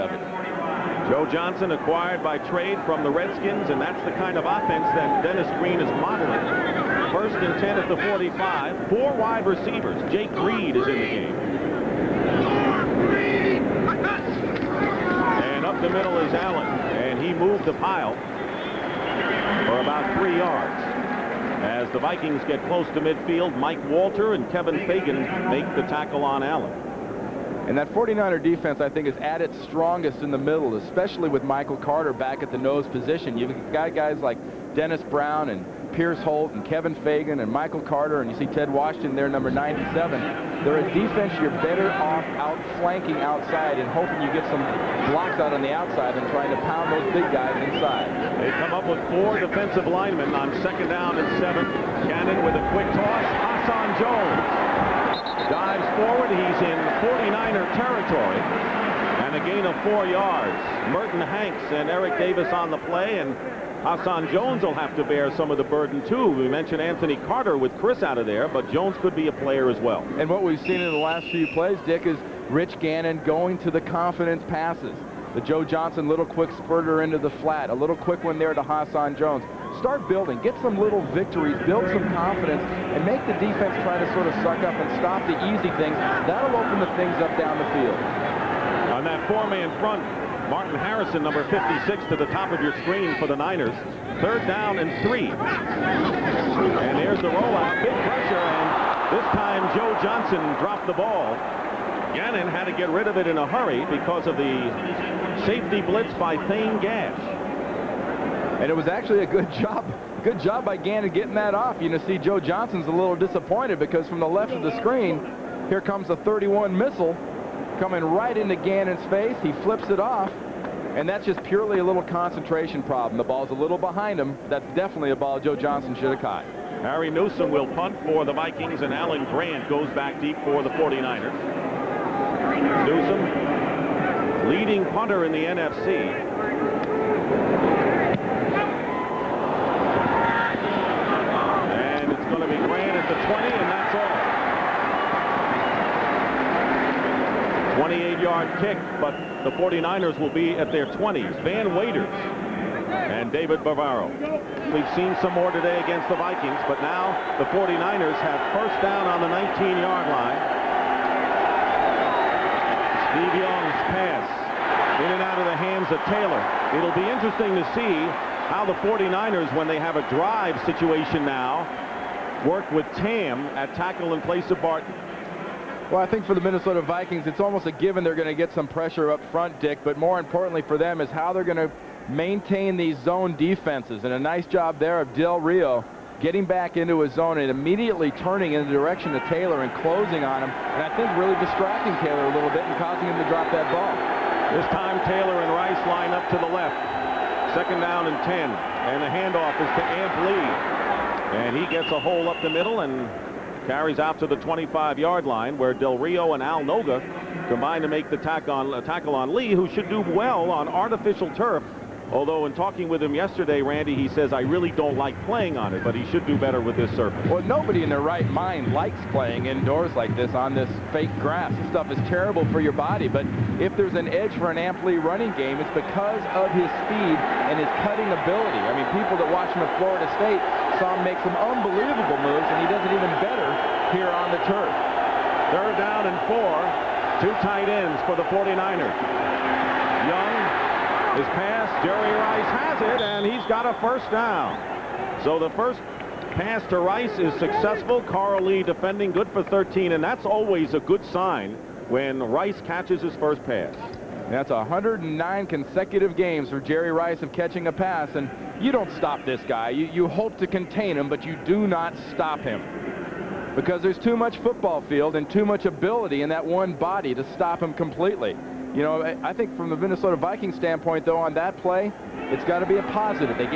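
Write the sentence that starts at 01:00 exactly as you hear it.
Merton Hanks and Eric Davis on the play.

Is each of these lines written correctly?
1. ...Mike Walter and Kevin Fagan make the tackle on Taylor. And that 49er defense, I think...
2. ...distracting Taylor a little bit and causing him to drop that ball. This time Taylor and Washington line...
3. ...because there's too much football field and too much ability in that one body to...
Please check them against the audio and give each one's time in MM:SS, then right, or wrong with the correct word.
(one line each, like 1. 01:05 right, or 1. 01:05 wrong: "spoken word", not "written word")
1. 00:23 wrong: "Allen", not "Taylor"
2. 03:11 wrong: "Rice", not "Washington"
3. 04:23 right.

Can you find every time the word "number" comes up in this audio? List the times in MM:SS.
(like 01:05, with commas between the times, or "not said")
00:39, 01:31.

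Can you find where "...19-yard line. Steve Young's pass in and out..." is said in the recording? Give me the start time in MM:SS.
02:39.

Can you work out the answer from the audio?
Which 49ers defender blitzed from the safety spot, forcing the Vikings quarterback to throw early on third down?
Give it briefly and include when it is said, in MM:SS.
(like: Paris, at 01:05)
Thane Gash, at 01:46.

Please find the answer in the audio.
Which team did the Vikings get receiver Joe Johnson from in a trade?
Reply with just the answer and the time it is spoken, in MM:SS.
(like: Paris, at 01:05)
Redskins, at 00:03.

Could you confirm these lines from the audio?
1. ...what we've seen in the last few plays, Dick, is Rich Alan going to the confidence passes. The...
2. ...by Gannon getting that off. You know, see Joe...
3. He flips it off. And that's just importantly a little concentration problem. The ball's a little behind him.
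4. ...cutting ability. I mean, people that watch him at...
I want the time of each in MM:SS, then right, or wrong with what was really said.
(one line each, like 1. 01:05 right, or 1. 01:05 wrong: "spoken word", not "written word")
1. 01:10 wrong: "Gannon", not "Alan"
2. 01:50 right
3. 01:59 wrong: "purely", not "importantly"
4. 03:47 right.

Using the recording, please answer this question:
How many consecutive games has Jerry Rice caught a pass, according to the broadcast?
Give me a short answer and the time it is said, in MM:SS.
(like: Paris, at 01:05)
109, at 04:14.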